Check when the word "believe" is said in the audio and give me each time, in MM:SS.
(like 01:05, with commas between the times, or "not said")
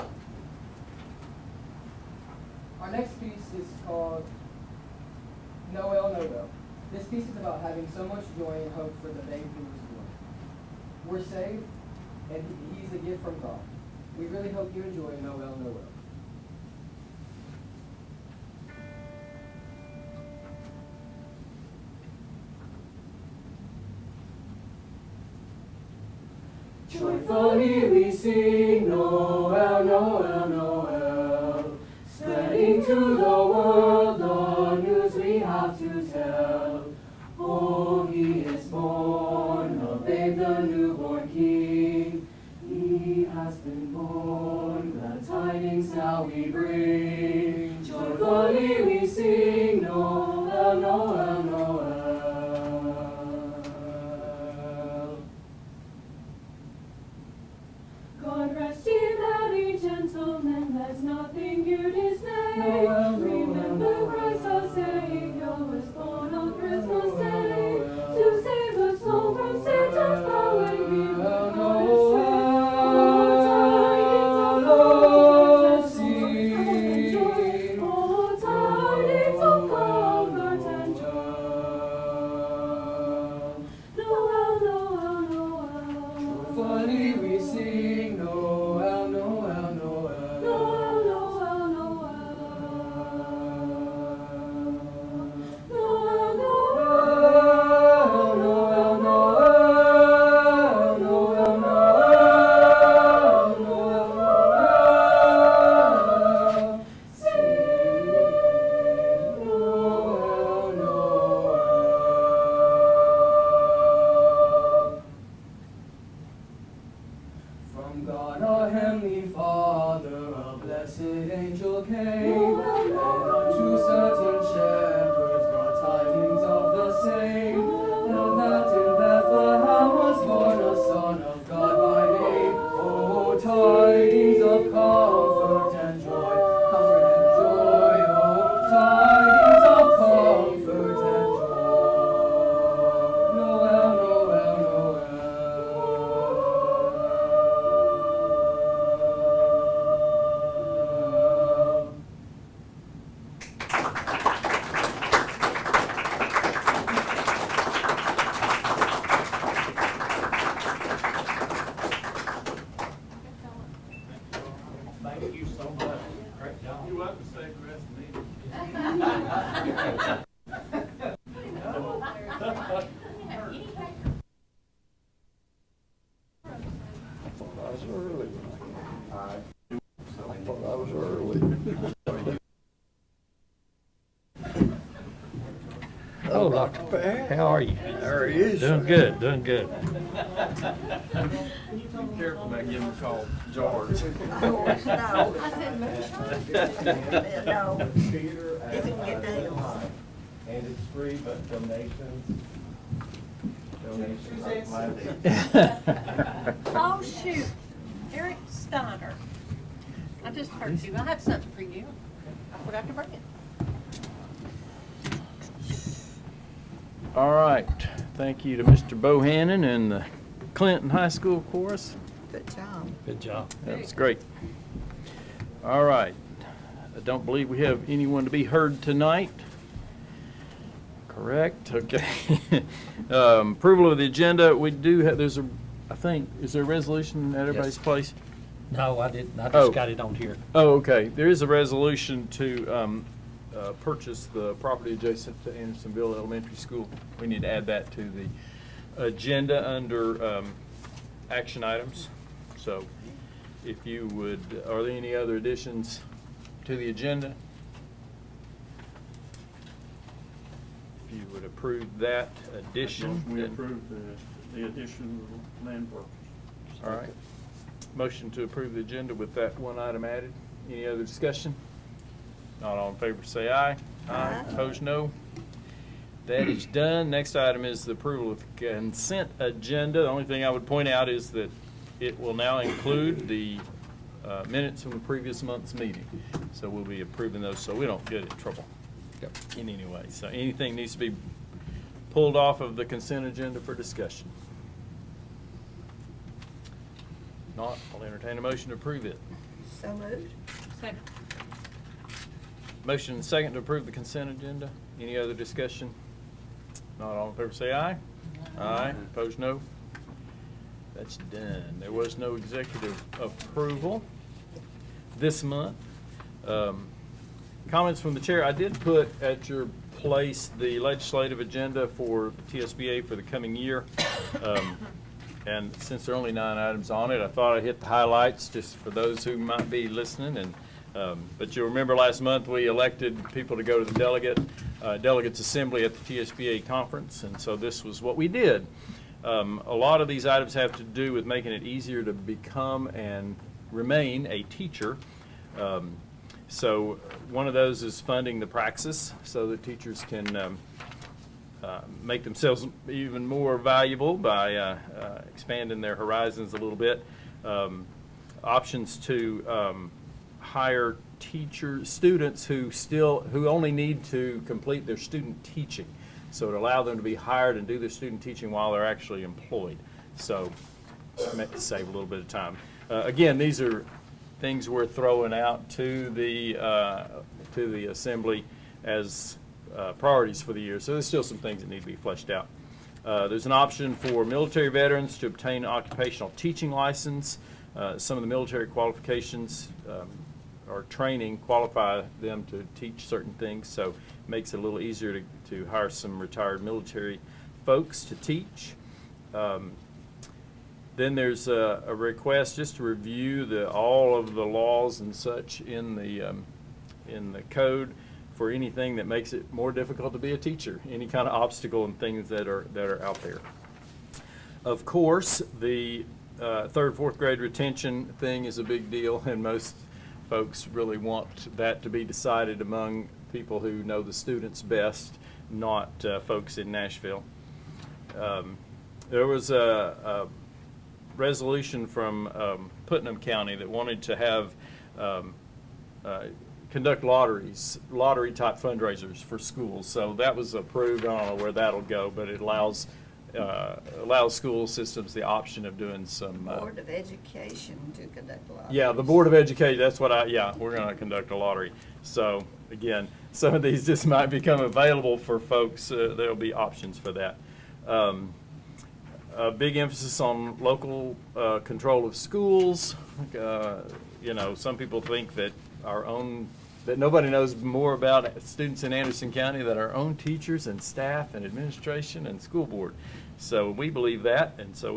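03:47, 07:53.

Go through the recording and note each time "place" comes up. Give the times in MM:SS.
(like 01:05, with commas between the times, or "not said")
03:57, 05:19.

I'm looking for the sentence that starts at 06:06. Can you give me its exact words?
So it allows them to be hired and do their student teaching while they're actually employed.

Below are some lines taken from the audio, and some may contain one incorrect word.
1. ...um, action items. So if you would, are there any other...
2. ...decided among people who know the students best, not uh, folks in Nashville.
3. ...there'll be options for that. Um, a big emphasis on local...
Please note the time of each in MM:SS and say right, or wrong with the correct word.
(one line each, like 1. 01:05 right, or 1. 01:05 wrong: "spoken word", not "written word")
1. 04:10 right
2. 07:02 right
3. 07:36 right.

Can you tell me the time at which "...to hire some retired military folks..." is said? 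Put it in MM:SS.
06:35.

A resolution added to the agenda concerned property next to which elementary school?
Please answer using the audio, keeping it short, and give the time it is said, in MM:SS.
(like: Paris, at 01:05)
Andersonville Elementary School, at 04:05.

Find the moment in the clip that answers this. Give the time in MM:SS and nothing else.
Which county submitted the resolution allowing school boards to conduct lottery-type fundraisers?
07:12.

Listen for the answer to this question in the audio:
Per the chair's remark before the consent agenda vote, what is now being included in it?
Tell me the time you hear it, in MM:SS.
04:44.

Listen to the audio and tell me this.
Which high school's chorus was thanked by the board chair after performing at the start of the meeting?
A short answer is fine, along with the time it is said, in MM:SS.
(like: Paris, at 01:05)
Clinton High School, at 03:40.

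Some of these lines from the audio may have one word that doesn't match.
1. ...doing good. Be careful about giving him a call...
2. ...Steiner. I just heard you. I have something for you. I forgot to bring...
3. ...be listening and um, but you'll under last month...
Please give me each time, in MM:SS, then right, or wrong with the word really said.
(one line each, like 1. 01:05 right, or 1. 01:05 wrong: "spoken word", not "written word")
1. 03:09 right
2. 03:28 right
3. 05:29 wrong: "remember", not "under".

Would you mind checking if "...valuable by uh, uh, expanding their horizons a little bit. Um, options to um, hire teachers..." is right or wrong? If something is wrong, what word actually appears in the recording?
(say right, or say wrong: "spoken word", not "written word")
right.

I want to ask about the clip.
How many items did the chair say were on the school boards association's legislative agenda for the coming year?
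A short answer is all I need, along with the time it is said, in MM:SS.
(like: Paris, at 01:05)
9, at 05:26.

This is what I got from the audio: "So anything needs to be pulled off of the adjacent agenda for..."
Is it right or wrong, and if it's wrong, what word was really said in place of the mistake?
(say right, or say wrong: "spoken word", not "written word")
wrong: "consent", not "adjacent".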